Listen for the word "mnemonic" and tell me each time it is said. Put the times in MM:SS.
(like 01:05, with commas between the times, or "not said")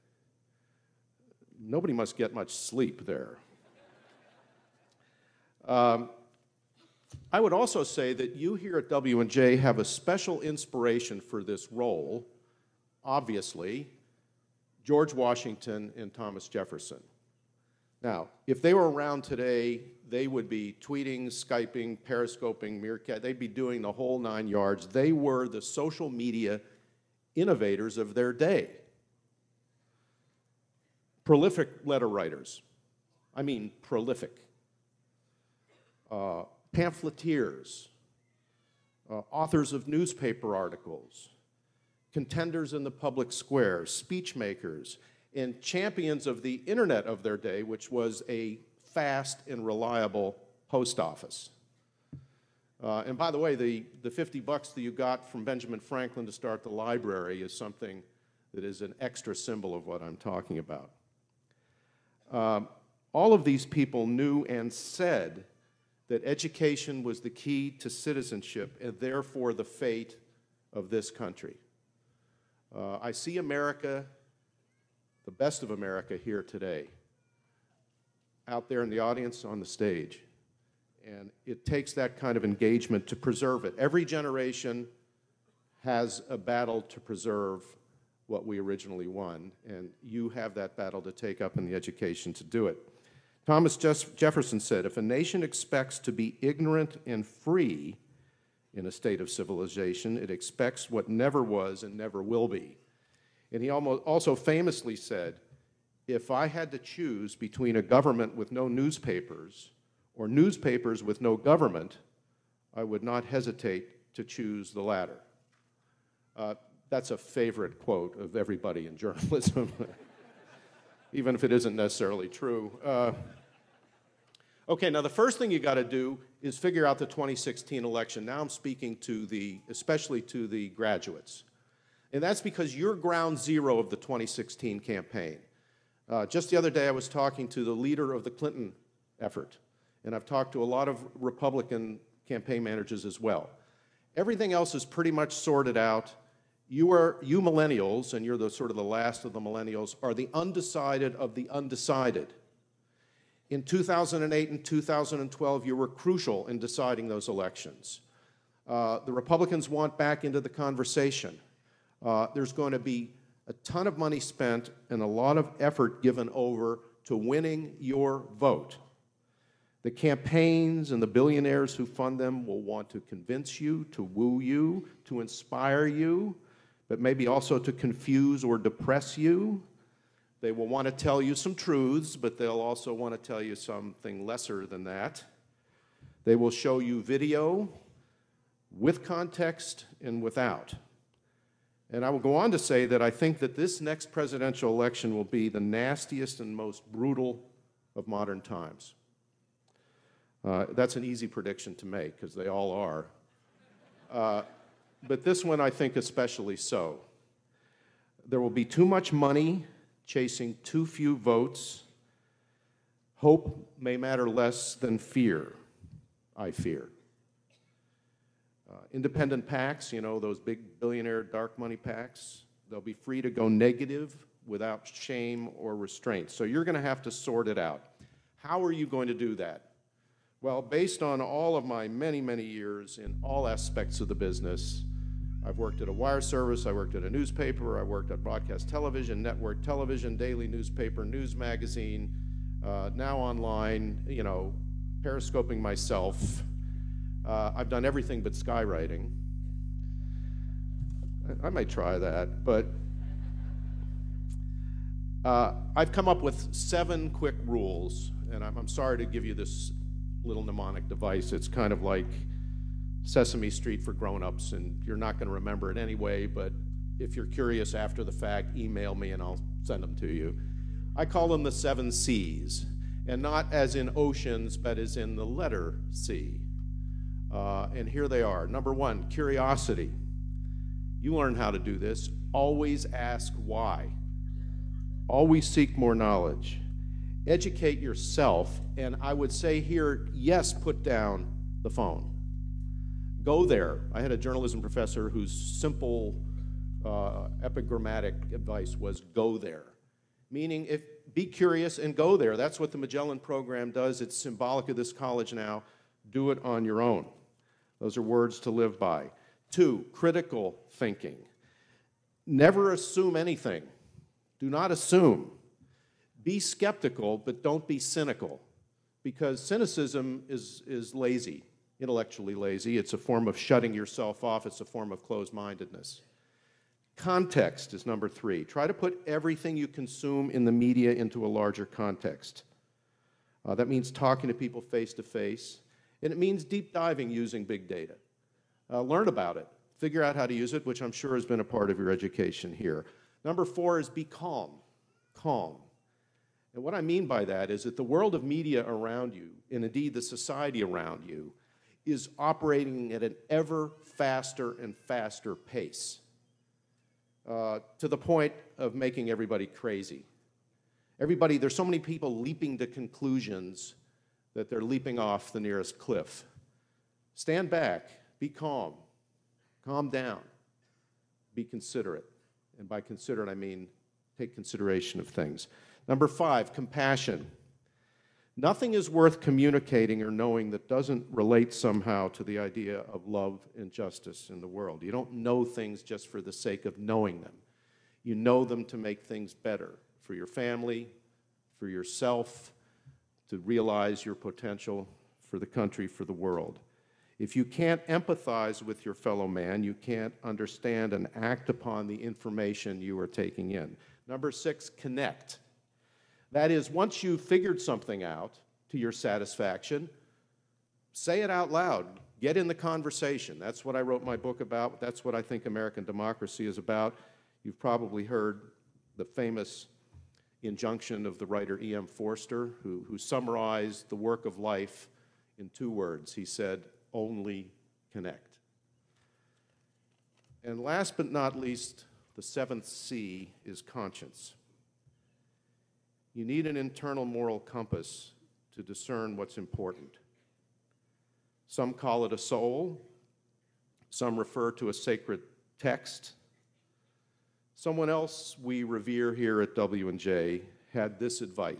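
04:20.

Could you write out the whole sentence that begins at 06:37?
If you can't empathize with your fellow man, you can't understand and act upon the information you are taking in.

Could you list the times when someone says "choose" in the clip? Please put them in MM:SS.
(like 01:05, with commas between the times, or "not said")
01:46, 01:54.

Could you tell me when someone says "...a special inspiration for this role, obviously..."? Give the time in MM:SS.
00:09.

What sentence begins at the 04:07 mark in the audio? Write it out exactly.
Uh, I've done everything but skywriting.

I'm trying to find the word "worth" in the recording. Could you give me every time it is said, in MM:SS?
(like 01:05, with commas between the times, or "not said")
06:18.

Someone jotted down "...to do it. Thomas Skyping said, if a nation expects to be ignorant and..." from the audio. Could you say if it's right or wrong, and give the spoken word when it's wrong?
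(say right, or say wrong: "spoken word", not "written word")
wrong: "Jefferson", not "Skyping".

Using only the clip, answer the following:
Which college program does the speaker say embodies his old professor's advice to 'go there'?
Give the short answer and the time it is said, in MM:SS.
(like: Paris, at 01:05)
the Magellan program, at 05:02.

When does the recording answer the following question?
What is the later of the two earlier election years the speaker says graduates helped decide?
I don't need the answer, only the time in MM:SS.
02:34.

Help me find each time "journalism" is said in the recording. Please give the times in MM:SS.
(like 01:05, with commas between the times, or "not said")
01:58, 04:54.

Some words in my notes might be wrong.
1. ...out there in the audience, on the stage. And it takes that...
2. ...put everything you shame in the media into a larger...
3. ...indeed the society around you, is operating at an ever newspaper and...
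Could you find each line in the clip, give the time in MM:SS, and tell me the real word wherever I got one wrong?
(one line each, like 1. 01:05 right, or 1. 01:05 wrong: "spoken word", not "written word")
1. 01:18 right
2. 05:28 wrong: "consume", not "shame"
3. 05:49 wrong: "faster", not "newspaper".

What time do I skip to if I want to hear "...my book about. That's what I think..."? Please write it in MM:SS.
06:54.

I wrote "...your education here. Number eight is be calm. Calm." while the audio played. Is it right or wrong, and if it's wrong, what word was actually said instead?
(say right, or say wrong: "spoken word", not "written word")
wrong: "four", not "eight".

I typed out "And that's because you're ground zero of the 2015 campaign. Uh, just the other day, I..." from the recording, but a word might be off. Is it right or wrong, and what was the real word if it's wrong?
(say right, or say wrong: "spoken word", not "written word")
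wrong: "2016", not "2015".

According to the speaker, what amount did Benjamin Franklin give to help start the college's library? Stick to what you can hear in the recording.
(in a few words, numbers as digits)
50 bucks.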